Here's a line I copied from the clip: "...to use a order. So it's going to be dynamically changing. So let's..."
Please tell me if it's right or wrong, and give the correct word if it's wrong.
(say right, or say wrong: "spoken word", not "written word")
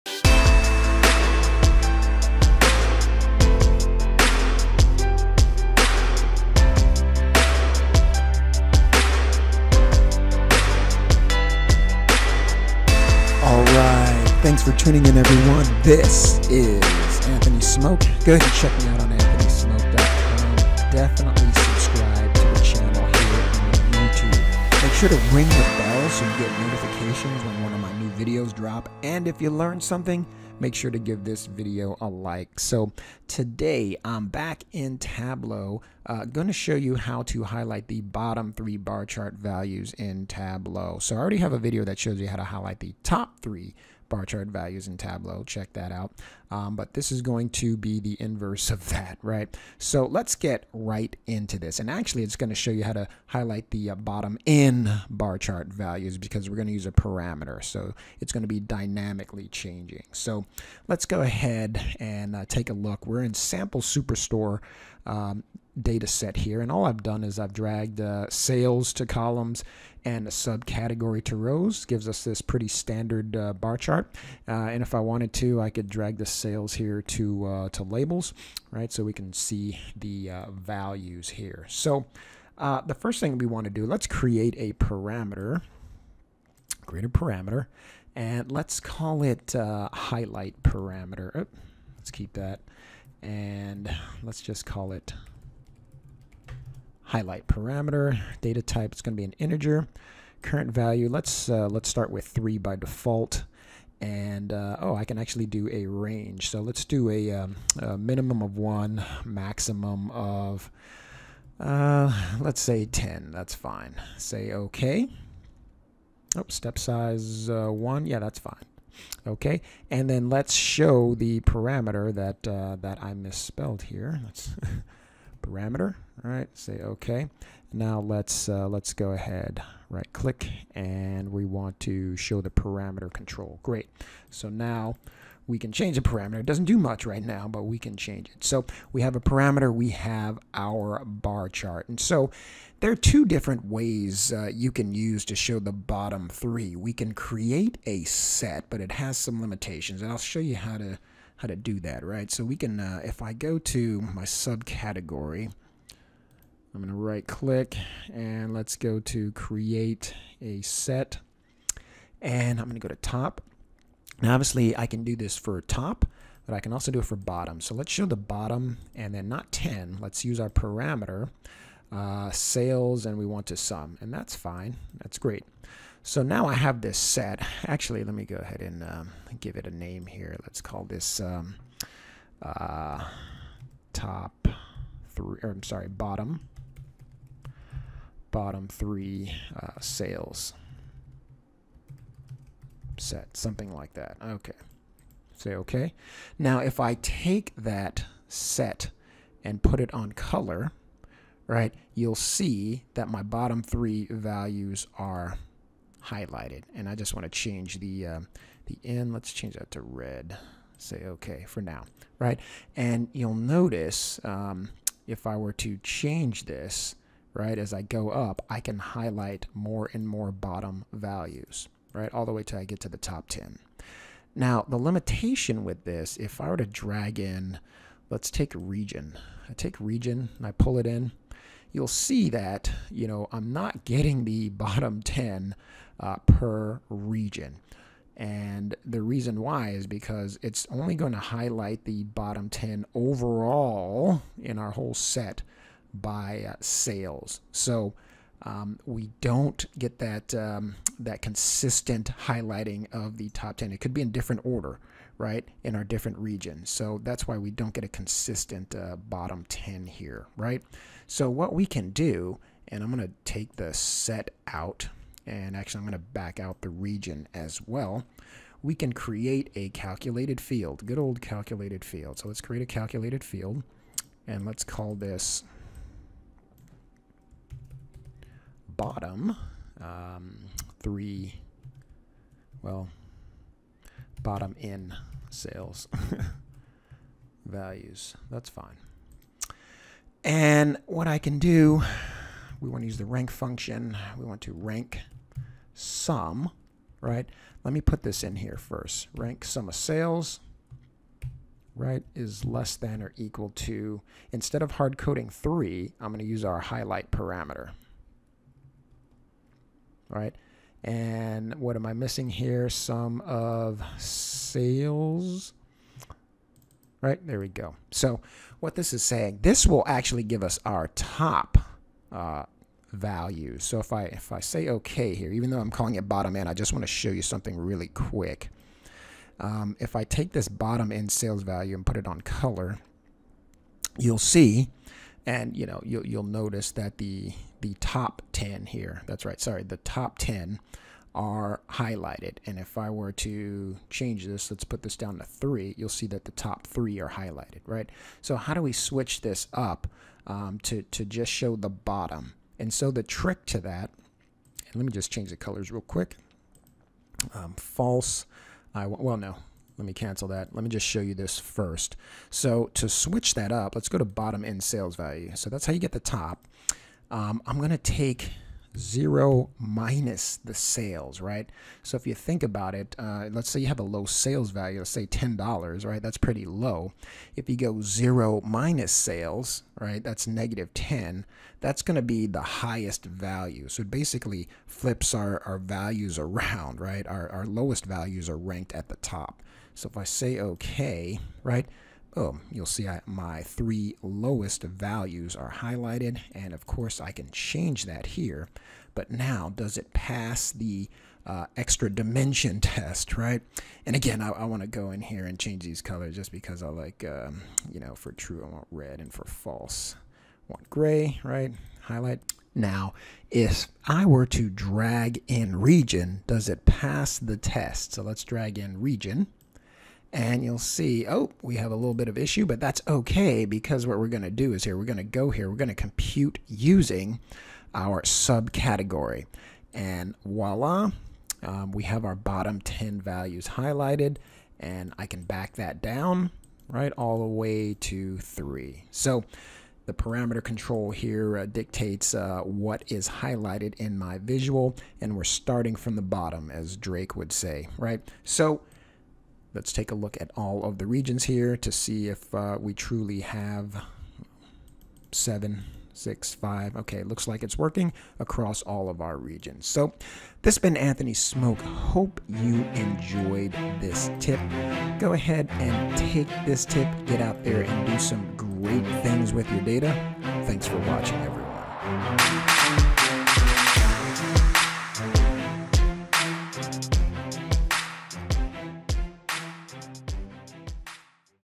wrong: "parameter", not "order".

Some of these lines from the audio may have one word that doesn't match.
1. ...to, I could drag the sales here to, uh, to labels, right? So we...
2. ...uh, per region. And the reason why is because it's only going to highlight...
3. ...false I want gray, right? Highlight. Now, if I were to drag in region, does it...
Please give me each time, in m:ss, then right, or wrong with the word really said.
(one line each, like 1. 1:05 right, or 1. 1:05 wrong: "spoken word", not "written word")
1. 1:15 right
2. 3:56 right
3. 6:49 right.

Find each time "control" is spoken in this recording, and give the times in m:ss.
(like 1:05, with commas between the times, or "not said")
2:13, 7:20.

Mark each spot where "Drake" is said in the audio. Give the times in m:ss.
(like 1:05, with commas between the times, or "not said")
7:26.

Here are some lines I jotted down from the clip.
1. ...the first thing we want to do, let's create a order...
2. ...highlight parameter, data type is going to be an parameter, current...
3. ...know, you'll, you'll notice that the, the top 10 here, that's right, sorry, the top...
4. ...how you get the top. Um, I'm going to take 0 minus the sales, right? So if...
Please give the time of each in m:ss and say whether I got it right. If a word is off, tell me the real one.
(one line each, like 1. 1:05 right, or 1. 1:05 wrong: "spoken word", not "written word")
1. 1:22 wrong: "parameter", not "order"
2. 1:37 wrong: "integer", not "parameter"
3. 5:35 right
4. 6:05 right.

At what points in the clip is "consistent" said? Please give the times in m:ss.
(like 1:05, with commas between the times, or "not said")
4:11, 4:17.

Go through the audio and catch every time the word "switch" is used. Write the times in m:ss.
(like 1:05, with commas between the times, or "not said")
5:48, 6:02.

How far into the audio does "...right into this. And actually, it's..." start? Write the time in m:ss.
0:50.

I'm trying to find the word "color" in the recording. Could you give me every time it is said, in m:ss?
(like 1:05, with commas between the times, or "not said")
3:20, 5:32, 5:55, 6:45.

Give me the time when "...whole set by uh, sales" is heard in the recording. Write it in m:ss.
4:04.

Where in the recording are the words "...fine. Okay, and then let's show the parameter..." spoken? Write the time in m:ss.
1:58.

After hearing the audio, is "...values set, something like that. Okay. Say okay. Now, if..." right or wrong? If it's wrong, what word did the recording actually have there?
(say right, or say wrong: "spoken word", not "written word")
wrong: "sales", not "values".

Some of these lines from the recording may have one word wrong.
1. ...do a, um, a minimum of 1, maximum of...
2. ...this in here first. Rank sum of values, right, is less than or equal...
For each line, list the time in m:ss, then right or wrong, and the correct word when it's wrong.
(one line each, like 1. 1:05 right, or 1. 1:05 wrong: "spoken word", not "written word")
1. 1:46 right
2. 4:58 wrong: "sales", not "values".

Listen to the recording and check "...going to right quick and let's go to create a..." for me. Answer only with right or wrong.
wrong.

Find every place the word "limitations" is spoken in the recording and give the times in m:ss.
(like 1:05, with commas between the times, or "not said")
2:29, 3:44.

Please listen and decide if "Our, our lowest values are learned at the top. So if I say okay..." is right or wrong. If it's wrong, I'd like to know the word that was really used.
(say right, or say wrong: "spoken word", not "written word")
wrong: "ranked", not "learned".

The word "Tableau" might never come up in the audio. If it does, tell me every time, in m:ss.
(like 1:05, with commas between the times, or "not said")
0:34, 0:40, 0:44.